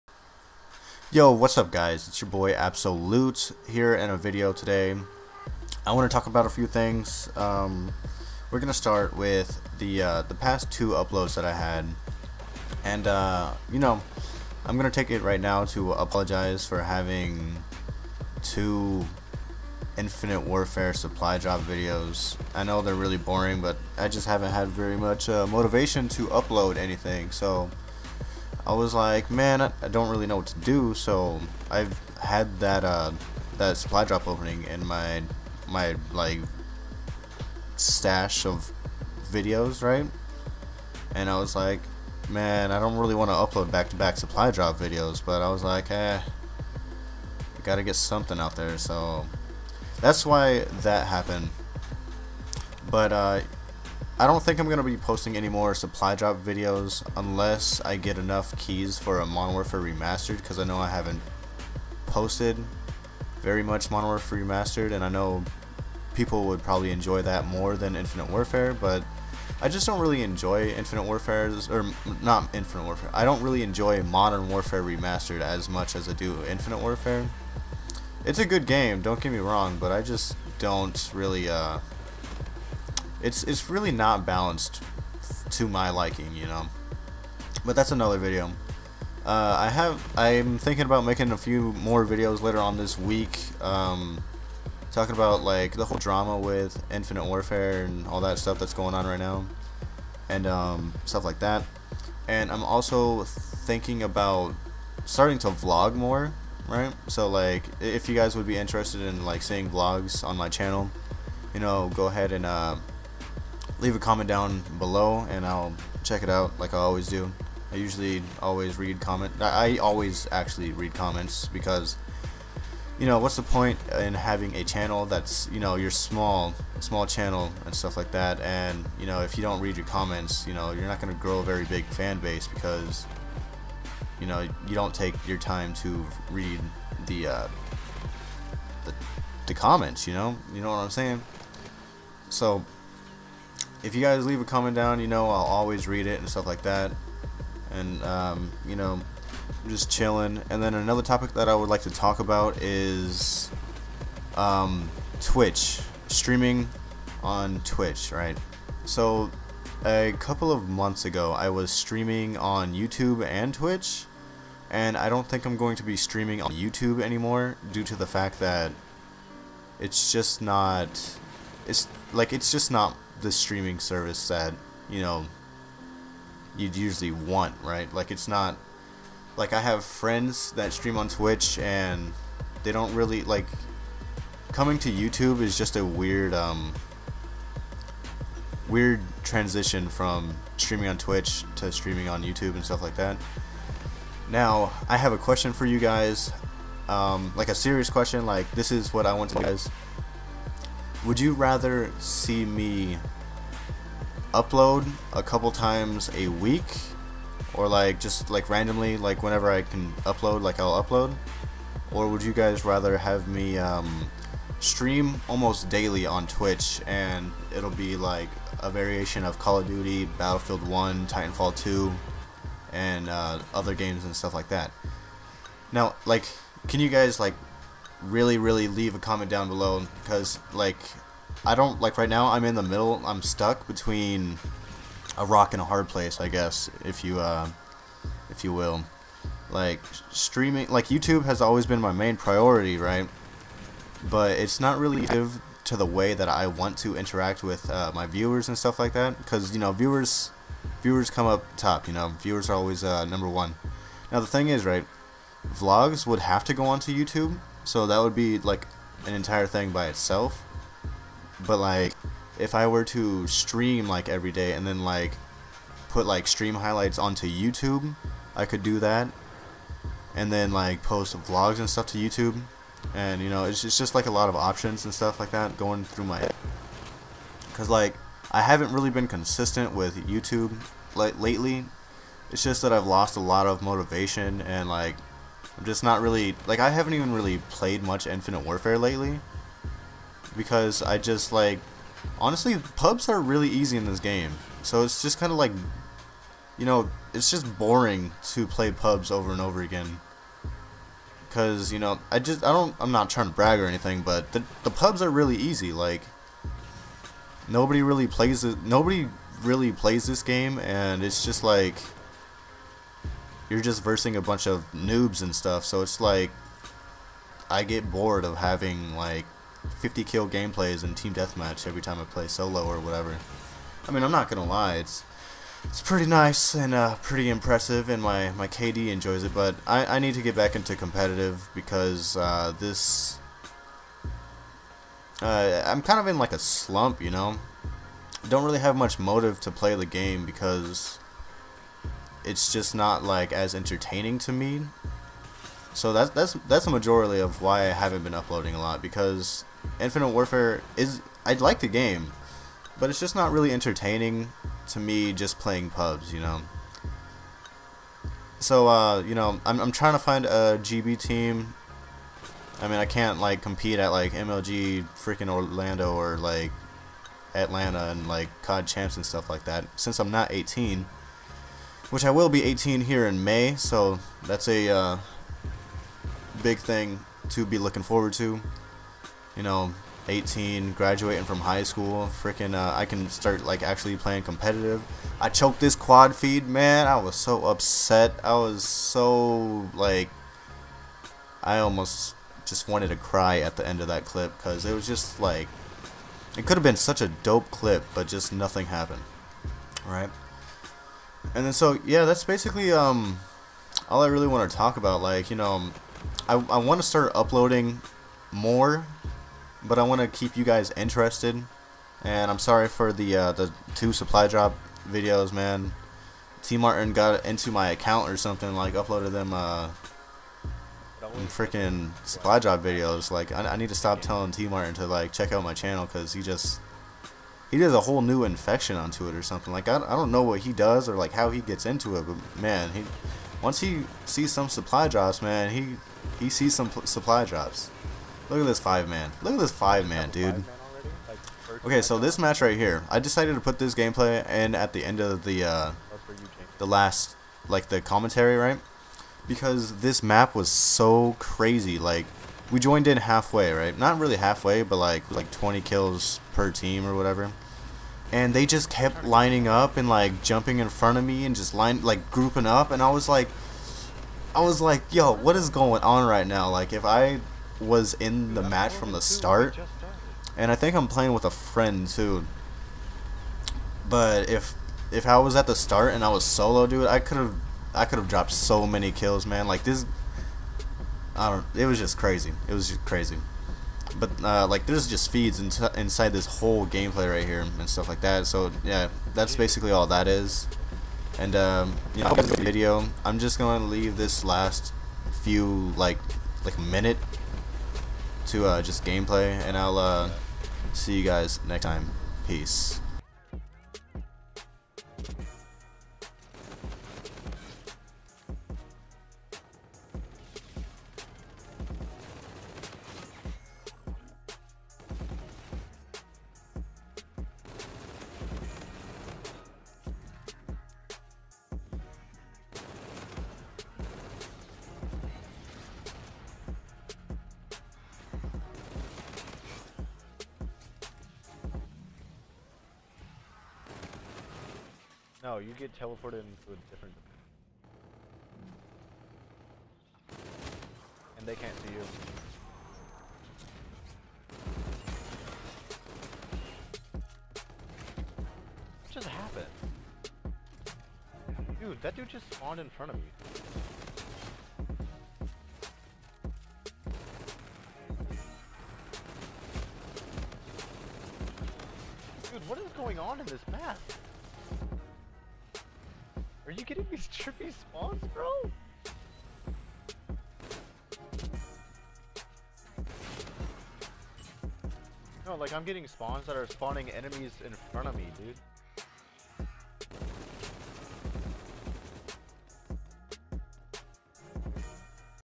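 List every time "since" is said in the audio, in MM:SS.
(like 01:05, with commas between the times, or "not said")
06:09.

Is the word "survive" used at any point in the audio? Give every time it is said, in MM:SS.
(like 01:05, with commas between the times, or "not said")
not said.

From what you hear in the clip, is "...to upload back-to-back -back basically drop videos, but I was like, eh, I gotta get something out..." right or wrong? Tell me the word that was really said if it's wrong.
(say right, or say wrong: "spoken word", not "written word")
wrong: "supply", not "basically".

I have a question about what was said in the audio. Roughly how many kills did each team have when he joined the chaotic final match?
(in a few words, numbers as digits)
20.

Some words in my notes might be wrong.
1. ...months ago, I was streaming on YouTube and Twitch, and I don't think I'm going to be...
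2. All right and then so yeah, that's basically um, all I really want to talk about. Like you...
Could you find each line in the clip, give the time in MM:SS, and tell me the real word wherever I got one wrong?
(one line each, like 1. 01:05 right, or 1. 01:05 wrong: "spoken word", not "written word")
1. 02:40 right
2. 06:39 right.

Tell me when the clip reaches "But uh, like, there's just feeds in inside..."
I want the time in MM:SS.
08:03.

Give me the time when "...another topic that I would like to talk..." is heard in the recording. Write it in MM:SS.
02:30.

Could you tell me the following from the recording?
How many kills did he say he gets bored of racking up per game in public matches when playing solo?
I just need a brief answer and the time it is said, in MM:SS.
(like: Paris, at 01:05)
50, at 05:19.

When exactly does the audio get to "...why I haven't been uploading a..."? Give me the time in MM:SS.
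05:47.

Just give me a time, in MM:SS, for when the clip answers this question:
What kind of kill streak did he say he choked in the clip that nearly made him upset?
06:25.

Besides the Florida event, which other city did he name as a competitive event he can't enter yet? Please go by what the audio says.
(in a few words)
Atlanta.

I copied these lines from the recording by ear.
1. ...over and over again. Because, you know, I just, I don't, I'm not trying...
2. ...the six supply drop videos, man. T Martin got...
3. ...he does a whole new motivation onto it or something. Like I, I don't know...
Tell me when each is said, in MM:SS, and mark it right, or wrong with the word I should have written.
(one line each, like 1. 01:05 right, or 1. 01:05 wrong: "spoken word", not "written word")
1. 04:59 right
2. 06:53 wrong: "two", not "six"
3. 07:07 wrong: "infection", not "motivation".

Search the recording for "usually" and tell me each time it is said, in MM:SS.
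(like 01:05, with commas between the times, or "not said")
01:57, 02:56.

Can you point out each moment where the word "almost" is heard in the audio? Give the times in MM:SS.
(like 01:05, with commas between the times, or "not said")
03:35, 06:31.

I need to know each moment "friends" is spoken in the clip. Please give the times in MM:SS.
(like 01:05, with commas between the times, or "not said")
02:59, 07:51.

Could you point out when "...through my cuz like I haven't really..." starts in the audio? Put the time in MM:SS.
04:35.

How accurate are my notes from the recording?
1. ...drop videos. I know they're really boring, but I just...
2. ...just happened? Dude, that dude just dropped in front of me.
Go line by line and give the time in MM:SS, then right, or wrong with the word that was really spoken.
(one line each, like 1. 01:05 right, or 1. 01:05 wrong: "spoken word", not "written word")
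1. 00:21 right
2. 09:08 wrong: "spawned", not "dropped".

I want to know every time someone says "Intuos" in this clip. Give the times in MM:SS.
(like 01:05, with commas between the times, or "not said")
not said.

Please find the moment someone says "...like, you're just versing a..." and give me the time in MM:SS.
05:11.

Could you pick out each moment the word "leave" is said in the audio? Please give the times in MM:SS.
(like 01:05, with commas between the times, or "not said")
01:53, 02:24, 03:48, 08:13.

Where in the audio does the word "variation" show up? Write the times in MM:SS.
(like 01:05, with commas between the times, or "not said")
03:38.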